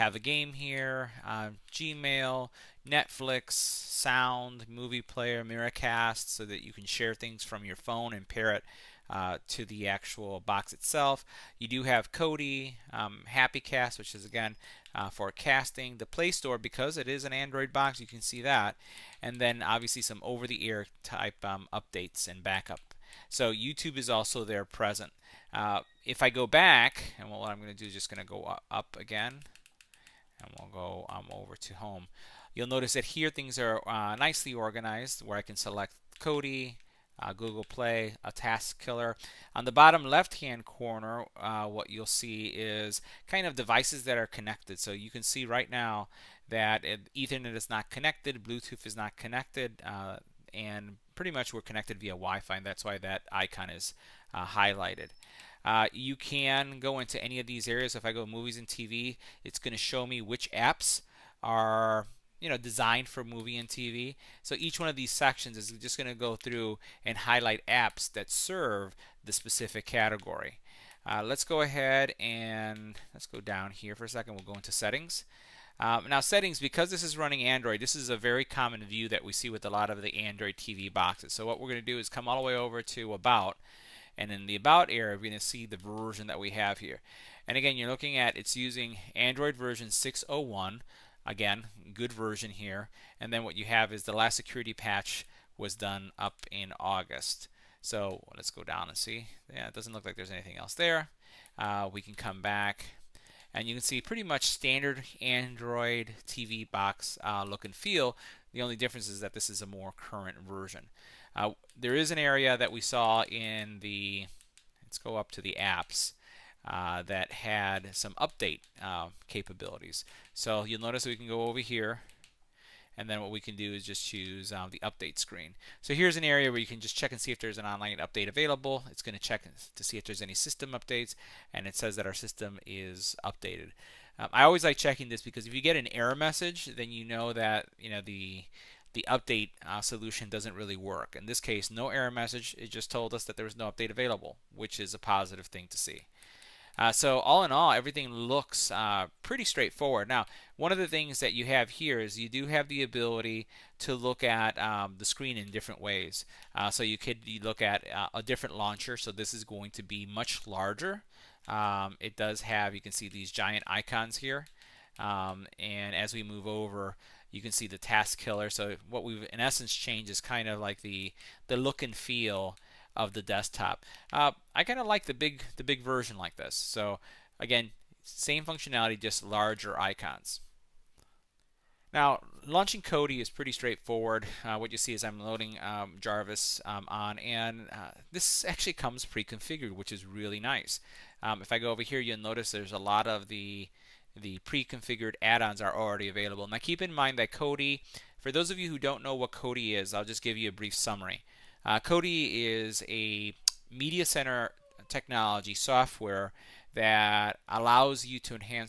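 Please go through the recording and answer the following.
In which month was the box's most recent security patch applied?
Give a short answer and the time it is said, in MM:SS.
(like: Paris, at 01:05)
August, at 01:36.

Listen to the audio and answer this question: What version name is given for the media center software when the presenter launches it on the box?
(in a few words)
Jarvis.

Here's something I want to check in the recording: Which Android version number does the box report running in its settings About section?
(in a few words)
6.0.1.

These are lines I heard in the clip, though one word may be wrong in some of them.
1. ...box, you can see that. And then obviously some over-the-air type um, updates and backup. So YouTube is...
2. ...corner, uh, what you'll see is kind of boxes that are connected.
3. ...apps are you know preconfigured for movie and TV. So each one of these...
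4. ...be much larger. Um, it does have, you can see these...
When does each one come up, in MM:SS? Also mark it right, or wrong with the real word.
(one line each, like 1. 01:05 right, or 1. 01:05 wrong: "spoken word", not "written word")
1. 00:17 right
2. 00:40 wrong: "devices", not "boxes"
3. 01:00 wrong: "designed", not "preconfigured"
4. 02:39 right.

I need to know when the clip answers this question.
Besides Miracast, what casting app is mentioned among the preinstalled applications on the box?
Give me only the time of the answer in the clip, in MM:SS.
00:13.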